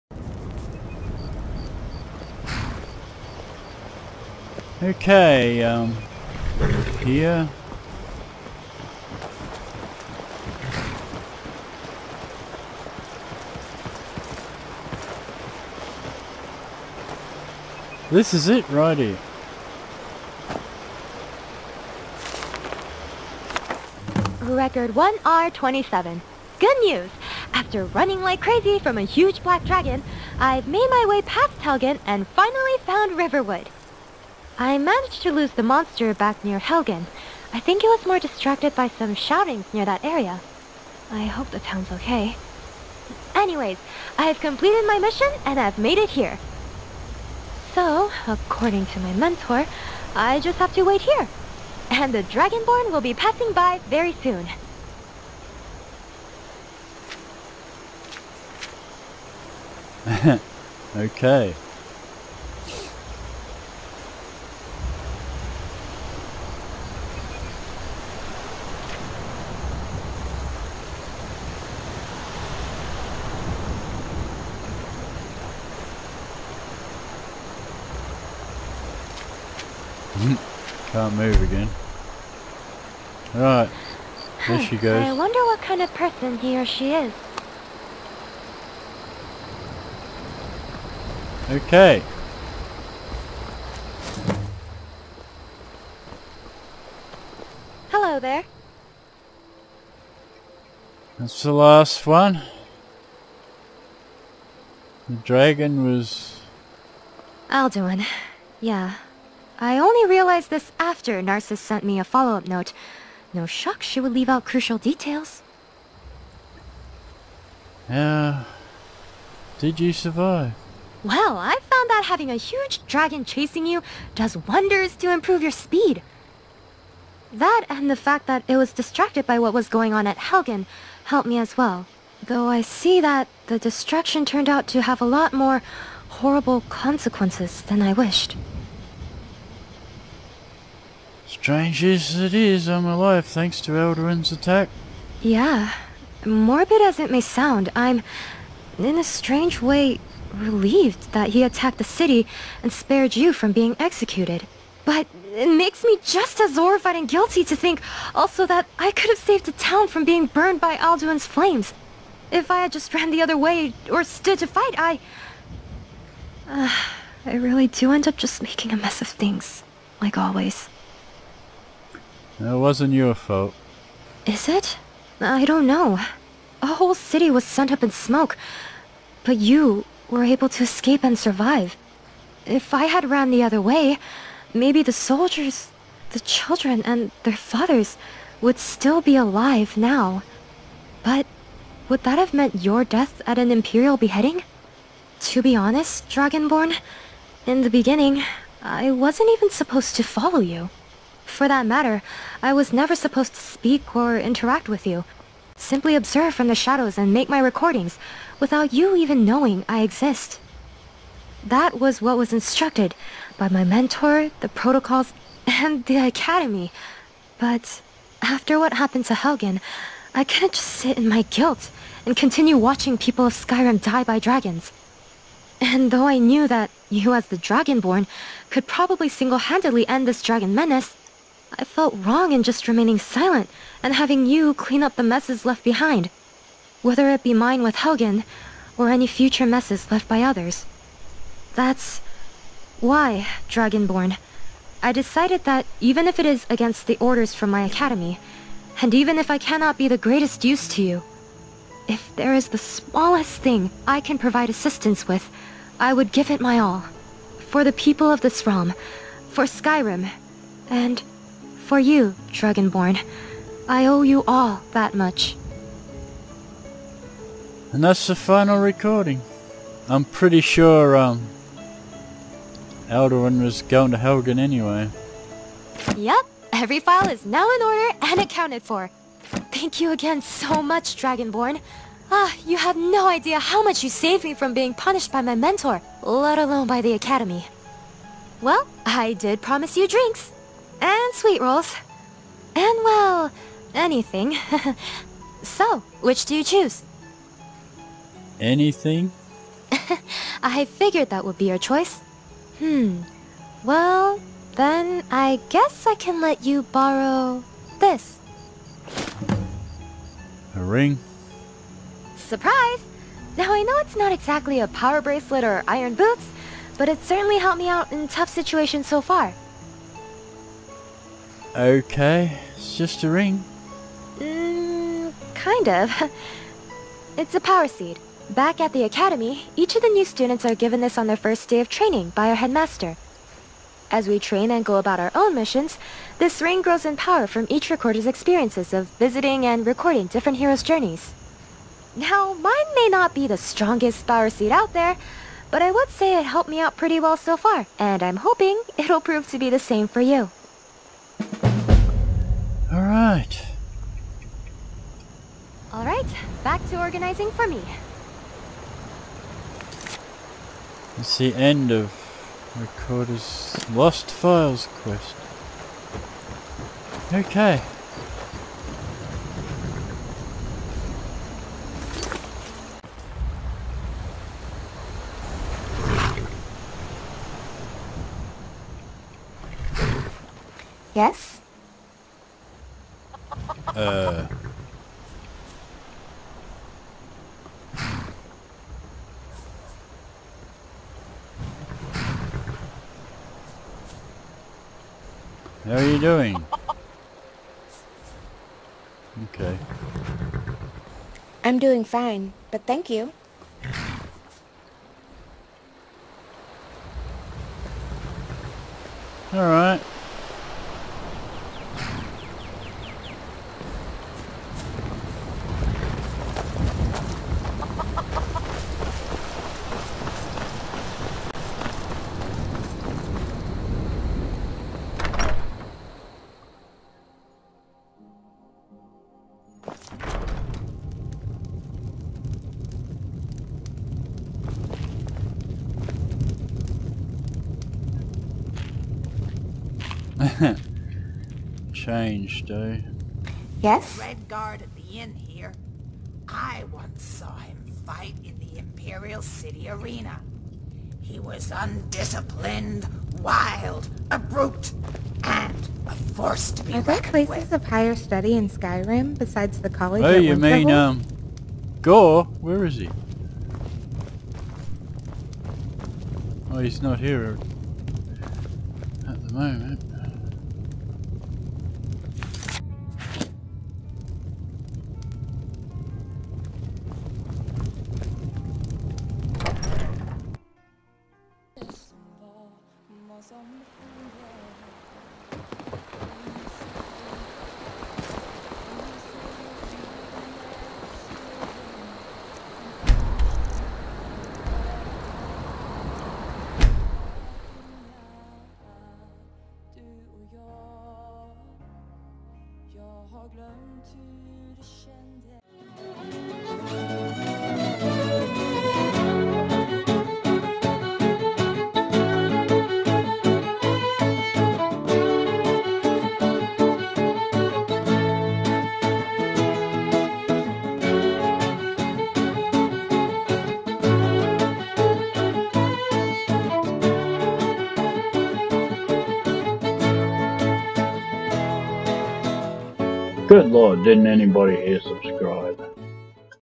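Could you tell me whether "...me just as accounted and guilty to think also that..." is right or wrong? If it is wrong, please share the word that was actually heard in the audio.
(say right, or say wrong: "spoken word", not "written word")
wrong: "horrified", not "accounted".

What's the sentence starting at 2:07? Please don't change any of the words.
That and the fact that it was distracted by what was going on at Helgen helped me as well.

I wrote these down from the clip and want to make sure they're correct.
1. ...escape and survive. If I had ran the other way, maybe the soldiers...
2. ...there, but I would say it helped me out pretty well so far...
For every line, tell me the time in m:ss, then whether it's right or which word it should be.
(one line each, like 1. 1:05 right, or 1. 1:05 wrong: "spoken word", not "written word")
1. 3:00 right
2. 5:44 right.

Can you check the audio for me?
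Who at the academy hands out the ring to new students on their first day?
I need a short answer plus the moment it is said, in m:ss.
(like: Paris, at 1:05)
headmaster, at 5:32.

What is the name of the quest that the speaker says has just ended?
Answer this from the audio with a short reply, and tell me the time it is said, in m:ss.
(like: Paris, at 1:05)
Recorder's Lost Files, at 6:02.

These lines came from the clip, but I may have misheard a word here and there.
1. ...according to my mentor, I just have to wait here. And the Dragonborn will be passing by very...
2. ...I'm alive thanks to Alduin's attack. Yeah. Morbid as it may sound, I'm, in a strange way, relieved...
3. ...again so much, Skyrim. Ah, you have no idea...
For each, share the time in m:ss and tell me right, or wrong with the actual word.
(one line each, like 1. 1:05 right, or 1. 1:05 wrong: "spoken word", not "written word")
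1. 0:48 right
2. 2:22 right
3. 4:39 wrong: "Dragonborn", not "Skyrim".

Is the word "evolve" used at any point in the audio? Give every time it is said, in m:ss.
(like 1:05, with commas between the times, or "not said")
not said.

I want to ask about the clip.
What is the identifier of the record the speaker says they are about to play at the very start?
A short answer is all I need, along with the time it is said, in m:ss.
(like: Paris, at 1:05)
1R27, at 0:24.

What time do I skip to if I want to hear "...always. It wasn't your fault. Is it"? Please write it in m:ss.
2:50.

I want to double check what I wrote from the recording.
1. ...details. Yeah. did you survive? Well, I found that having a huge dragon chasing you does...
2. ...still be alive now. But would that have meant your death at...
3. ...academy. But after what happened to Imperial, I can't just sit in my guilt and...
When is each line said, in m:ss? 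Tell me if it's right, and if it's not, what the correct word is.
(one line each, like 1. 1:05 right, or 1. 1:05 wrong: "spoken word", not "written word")
1. 1:54 right
2. 3:08 right
3. 3:36 wrong: "Helgen", not "Imperial".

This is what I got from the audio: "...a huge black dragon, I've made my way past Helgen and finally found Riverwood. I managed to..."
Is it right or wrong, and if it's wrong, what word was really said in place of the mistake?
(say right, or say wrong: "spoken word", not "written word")
right.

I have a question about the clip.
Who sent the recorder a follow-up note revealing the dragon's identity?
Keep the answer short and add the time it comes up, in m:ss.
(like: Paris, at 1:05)
Narcissus, at 1:51.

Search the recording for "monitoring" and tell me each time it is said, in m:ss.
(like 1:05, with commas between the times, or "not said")
not said.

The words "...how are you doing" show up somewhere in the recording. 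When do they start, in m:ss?
6:35.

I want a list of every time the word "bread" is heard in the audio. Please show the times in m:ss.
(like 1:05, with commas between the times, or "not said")
not said.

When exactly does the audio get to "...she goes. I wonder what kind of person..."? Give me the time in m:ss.
1:24.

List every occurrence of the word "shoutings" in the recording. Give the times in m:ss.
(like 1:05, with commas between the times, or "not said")
0:39.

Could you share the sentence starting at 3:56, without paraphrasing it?
Whether it be mine with Helgen, or any future messes left by others.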